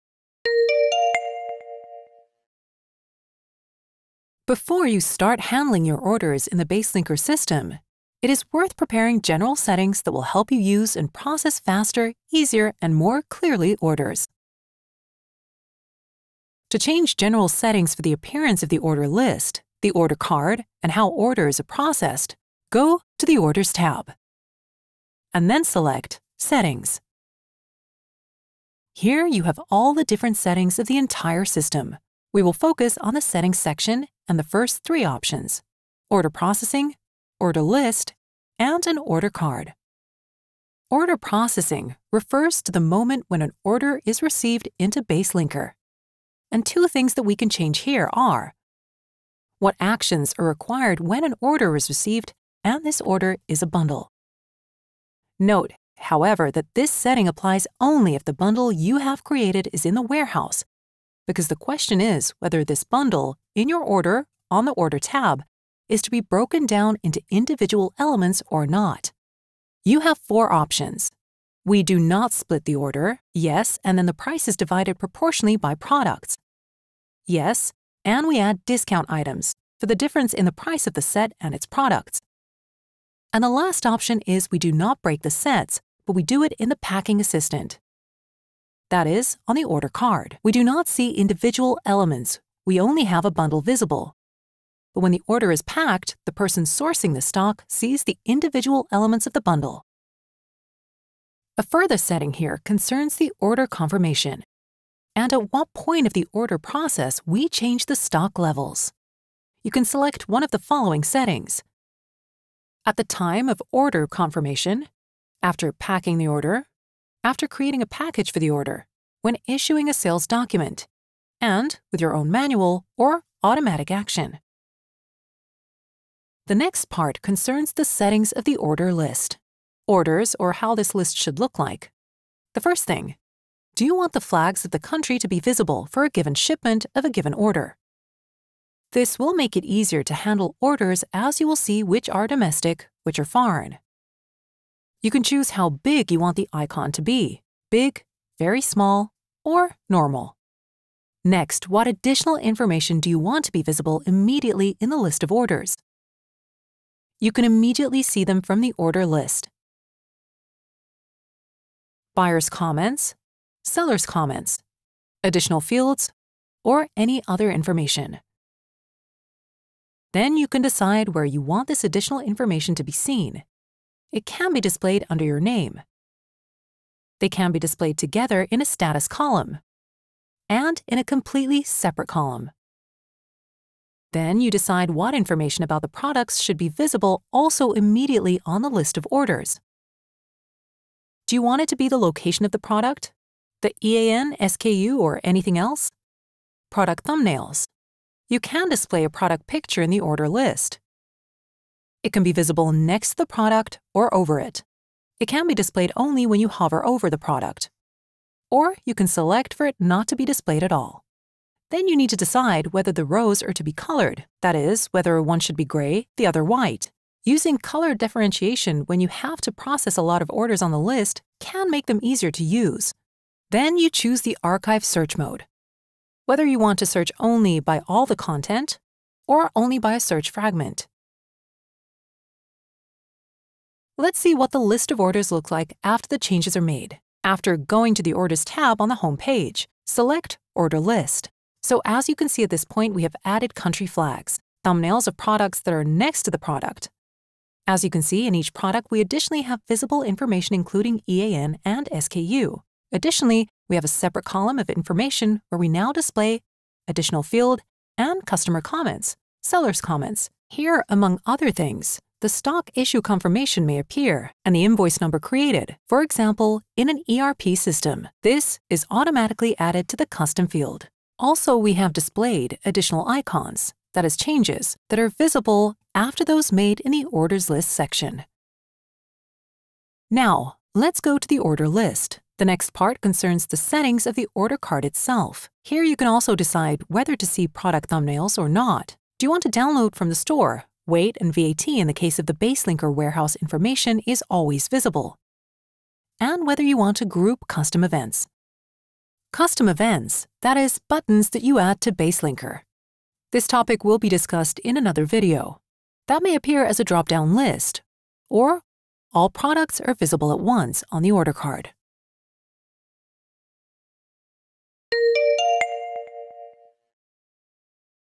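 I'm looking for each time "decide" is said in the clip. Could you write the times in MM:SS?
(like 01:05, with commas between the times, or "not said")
02:50, 03:04, 03:32, 04:46.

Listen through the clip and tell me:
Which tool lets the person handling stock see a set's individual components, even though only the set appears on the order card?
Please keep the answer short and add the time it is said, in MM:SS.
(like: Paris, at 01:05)
Packing Assistant, at 01:26.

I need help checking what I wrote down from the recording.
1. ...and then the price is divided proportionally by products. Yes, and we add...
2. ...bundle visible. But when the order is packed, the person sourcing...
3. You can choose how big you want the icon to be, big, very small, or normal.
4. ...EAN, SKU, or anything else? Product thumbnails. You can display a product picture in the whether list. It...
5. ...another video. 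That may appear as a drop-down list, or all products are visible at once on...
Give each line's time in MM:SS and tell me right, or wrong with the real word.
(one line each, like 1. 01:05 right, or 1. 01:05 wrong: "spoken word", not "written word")
1. 01:13 right
2. 01:33 right
3. 02:25 right
4. 03:13 wrong: "order", not "whether"
5. 05:04 right.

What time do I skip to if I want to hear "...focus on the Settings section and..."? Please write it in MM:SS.
00:32.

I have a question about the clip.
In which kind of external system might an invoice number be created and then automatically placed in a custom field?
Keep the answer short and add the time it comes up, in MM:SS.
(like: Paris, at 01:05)
ERP system, at 04:27.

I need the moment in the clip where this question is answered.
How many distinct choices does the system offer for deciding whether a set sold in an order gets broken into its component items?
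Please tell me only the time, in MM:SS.
01:10.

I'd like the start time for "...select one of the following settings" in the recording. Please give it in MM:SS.
01:49.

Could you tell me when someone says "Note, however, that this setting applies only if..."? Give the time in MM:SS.
00:55.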